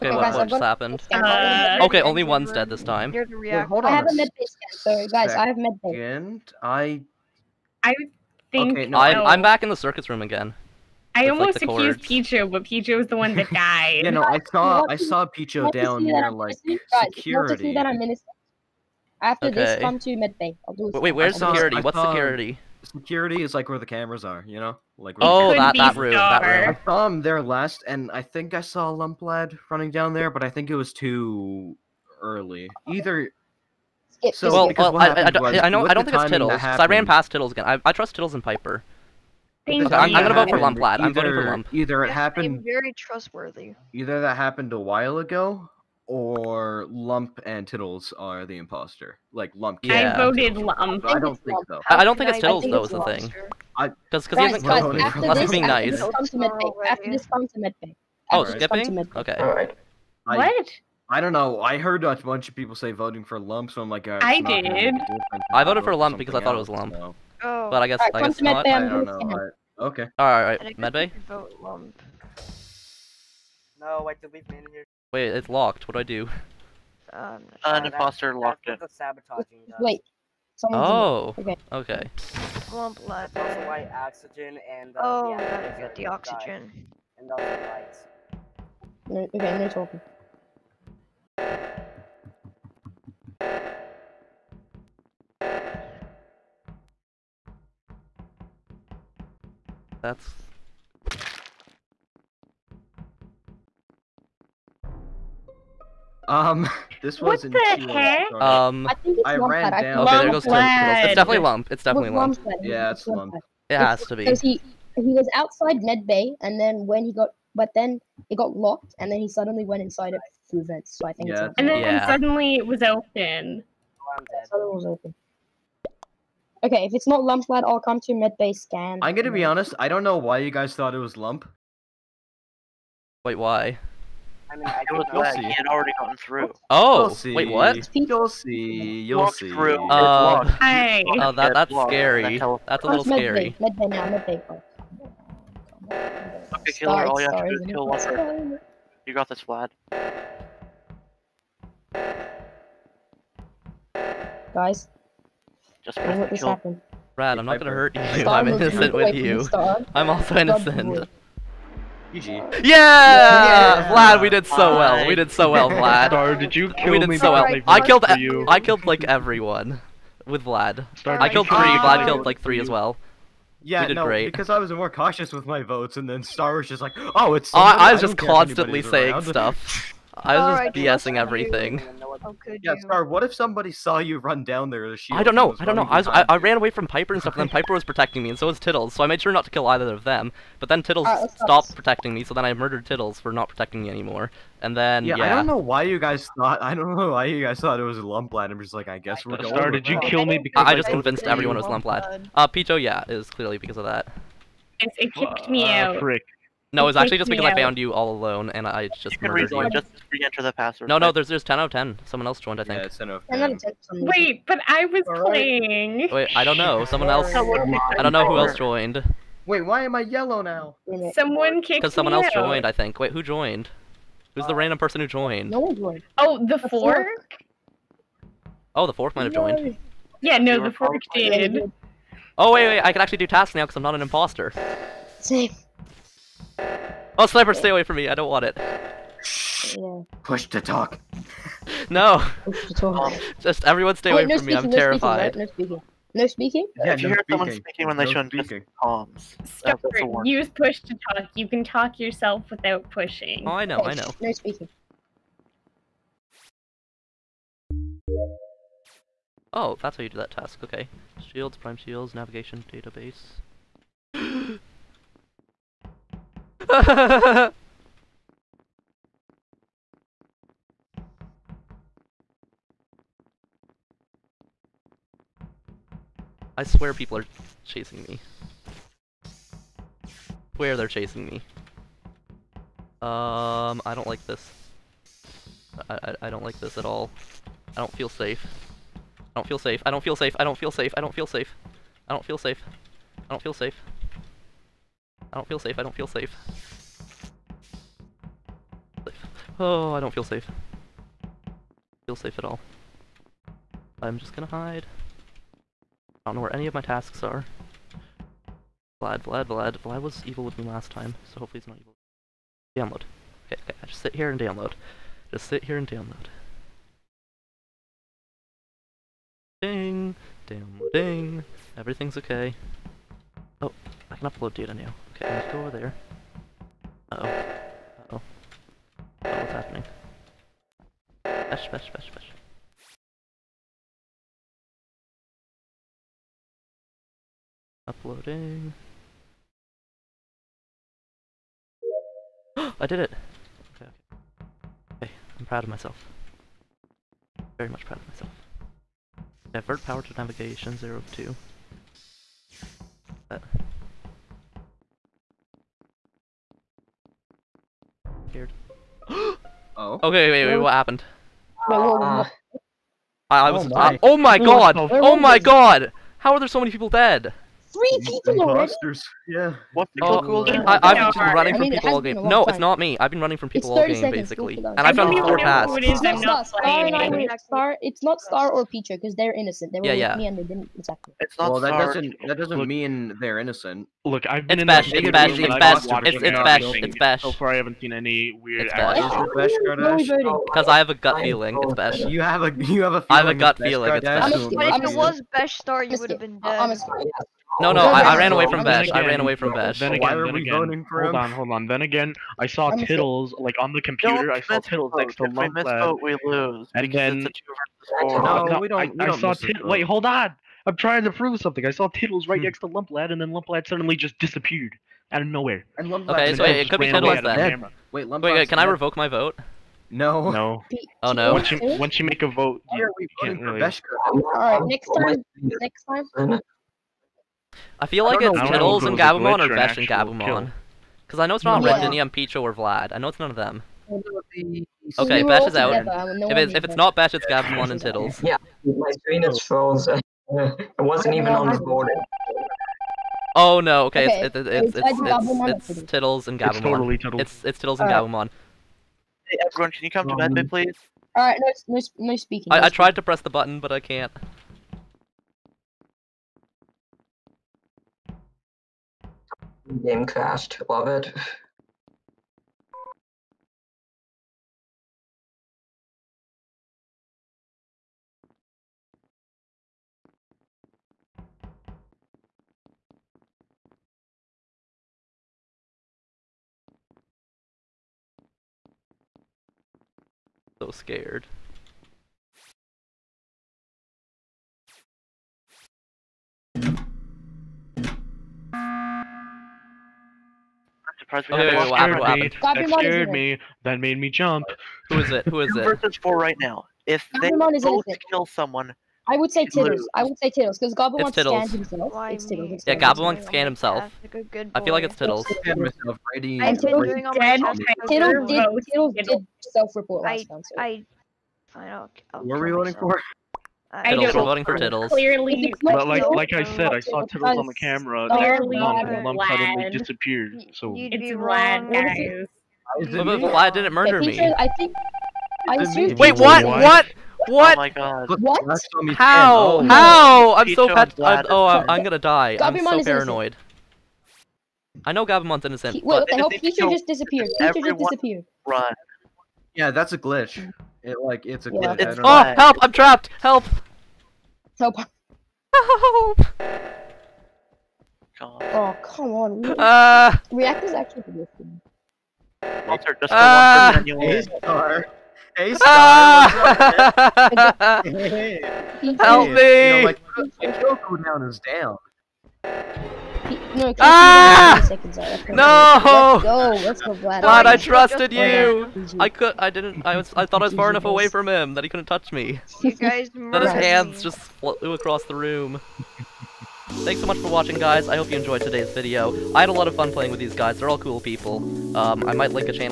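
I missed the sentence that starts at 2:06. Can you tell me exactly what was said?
Okay, if it's not lump lad, I'll come to med bay scan.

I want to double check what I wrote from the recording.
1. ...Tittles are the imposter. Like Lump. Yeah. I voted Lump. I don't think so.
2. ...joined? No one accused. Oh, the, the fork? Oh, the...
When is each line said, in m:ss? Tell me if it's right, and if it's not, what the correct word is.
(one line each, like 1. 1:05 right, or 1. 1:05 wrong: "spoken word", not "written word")
1. 0:47 right
2. 3:45 wrong: "joined", not "accused".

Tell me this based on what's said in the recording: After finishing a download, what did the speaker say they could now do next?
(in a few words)
upload data.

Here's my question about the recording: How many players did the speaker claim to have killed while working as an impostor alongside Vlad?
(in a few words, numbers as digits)
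3.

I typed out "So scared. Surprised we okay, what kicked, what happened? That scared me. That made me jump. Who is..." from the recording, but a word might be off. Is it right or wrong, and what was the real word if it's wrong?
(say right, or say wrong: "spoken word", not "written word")
wrong: "happened", not "kicked".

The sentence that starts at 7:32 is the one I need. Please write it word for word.
I, I tried to press the button, but I can't.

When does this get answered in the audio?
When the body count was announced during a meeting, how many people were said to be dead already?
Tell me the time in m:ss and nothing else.
6:07.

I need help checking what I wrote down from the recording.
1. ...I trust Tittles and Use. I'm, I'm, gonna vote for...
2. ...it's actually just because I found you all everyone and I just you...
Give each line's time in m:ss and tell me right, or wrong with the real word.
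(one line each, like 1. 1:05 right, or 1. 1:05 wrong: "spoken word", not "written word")
1. 0:37 wrong: "Piper", not "Use"
2. 3:26 wrong: "alone", not "everyone".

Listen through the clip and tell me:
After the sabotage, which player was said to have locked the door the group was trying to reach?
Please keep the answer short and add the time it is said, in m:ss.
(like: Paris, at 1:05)
Foster, at 1:17.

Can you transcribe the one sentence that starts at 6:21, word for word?
It's not well, that doesn't that doesn't look, mean they're innocent.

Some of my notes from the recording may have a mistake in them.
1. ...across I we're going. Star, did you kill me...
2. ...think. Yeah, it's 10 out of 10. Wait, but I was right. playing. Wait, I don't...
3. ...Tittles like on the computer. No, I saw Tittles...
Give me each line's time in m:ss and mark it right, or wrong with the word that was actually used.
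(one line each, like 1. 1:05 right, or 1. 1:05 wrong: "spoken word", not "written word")
1. 3:18 wrong: "guess", not "across"
2. 3:32 right
3. 6:42 right.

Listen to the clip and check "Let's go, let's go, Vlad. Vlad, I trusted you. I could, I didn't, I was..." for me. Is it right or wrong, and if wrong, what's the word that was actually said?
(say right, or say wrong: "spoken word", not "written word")
right.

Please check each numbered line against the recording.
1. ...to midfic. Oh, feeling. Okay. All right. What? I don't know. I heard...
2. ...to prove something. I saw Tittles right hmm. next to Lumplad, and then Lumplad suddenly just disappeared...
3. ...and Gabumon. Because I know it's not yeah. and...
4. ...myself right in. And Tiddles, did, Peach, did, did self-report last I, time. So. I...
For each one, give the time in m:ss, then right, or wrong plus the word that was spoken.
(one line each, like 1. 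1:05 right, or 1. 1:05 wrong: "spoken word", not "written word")
1. 0:57 wrong: "skipping", not "feeling"
2. 6:51 right
3. 7:09 right
4. 8:25 wrong: "Tiddles", not "Peach".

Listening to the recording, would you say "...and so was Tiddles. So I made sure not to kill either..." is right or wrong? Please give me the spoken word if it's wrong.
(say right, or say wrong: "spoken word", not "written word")
right.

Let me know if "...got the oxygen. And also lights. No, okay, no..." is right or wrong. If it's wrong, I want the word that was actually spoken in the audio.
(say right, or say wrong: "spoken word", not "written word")
right.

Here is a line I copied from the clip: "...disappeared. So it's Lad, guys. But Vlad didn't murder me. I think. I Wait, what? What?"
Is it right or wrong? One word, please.
wrong.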